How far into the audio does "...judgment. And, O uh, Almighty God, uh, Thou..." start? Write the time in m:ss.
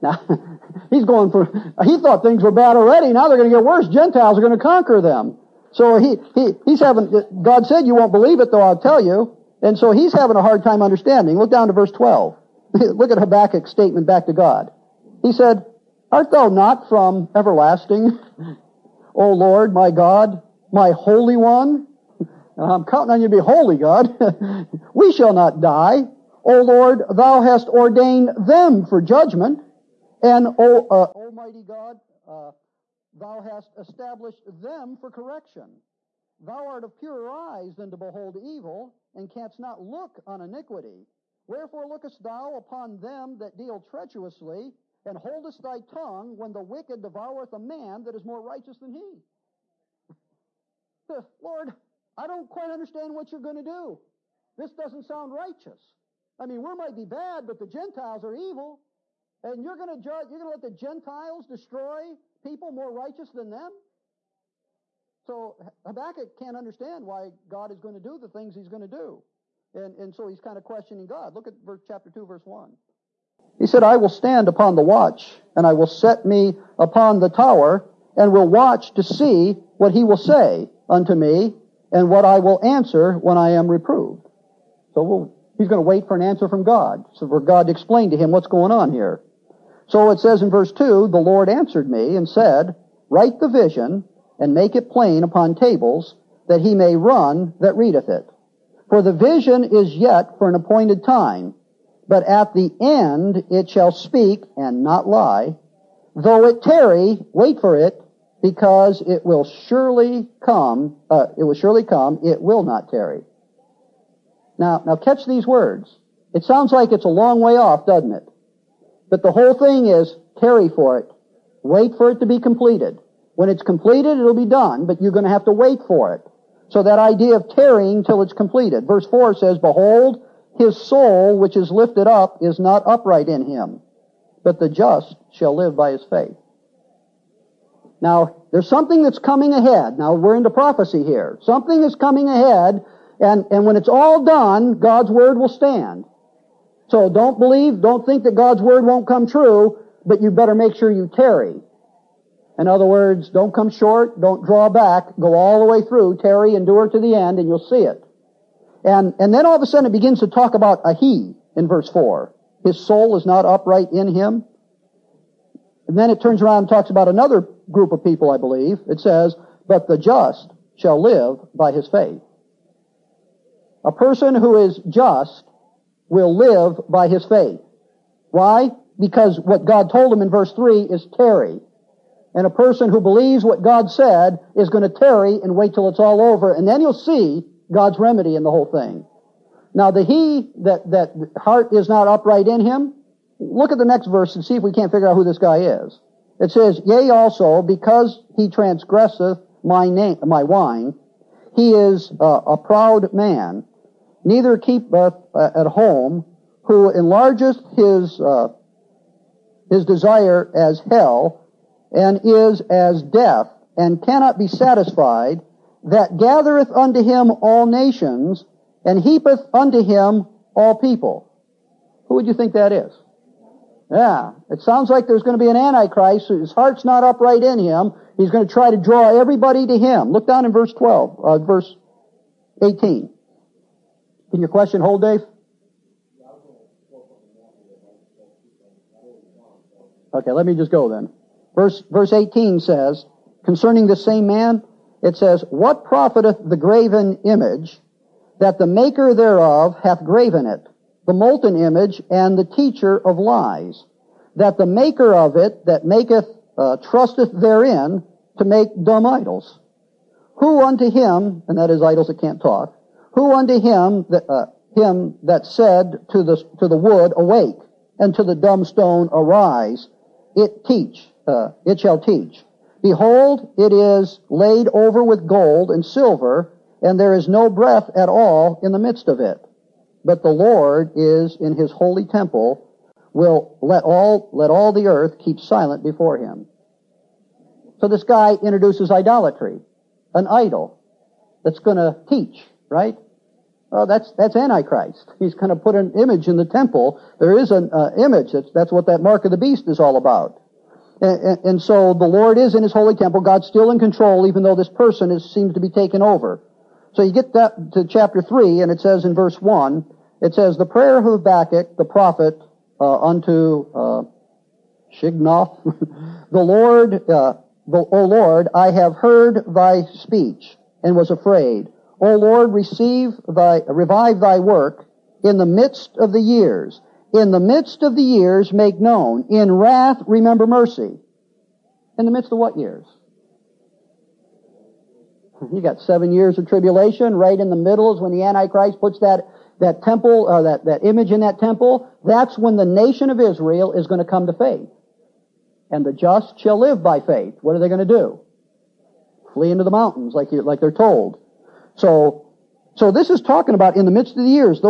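0:28.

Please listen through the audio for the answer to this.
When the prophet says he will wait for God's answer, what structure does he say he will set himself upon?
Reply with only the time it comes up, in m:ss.
1:17.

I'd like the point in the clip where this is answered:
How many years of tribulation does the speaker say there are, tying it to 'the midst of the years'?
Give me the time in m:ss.
5:35.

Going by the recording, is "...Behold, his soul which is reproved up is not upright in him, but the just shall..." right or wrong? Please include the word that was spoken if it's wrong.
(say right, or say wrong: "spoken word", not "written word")
wrong: "lifted", not "reproved".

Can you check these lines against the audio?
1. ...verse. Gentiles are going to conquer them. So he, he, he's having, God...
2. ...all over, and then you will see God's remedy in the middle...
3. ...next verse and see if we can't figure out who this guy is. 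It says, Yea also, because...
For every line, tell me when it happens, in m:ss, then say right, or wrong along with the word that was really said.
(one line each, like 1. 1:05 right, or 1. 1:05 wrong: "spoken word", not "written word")
1. 0:03 wrong: "worse", not "verse"
2. 3:05 wrong: "whole", not "middle"
3. 3:13 right.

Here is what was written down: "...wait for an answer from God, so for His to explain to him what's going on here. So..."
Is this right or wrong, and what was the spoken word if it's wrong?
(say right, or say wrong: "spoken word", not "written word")
wrong: "God", not "His".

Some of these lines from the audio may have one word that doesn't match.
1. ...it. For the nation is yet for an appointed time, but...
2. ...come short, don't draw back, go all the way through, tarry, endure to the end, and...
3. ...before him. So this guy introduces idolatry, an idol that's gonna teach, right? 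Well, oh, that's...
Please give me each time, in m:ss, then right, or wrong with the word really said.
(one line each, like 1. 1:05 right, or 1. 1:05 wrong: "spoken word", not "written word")
1. 1:38 wrong: "vision", not "nation"
2. 2:33 right
3. 4:45 right.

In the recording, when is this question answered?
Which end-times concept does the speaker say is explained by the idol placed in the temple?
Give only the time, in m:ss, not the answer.
4:59.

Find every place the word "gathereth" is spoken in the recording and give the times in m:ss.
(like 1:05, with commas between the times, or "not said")
3:36.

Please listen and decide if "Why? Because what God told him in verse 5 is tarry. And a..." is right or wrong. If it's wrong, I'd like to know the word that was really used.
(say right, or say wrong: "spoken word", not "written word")
wrong: "3", not "5".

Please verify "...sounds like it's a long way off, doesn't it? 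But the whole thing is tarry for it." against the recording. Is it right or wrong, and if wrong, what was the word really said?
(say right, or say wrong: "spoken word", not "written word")
right.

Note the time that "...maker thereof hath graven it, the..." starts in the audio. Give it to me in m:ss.
4:08.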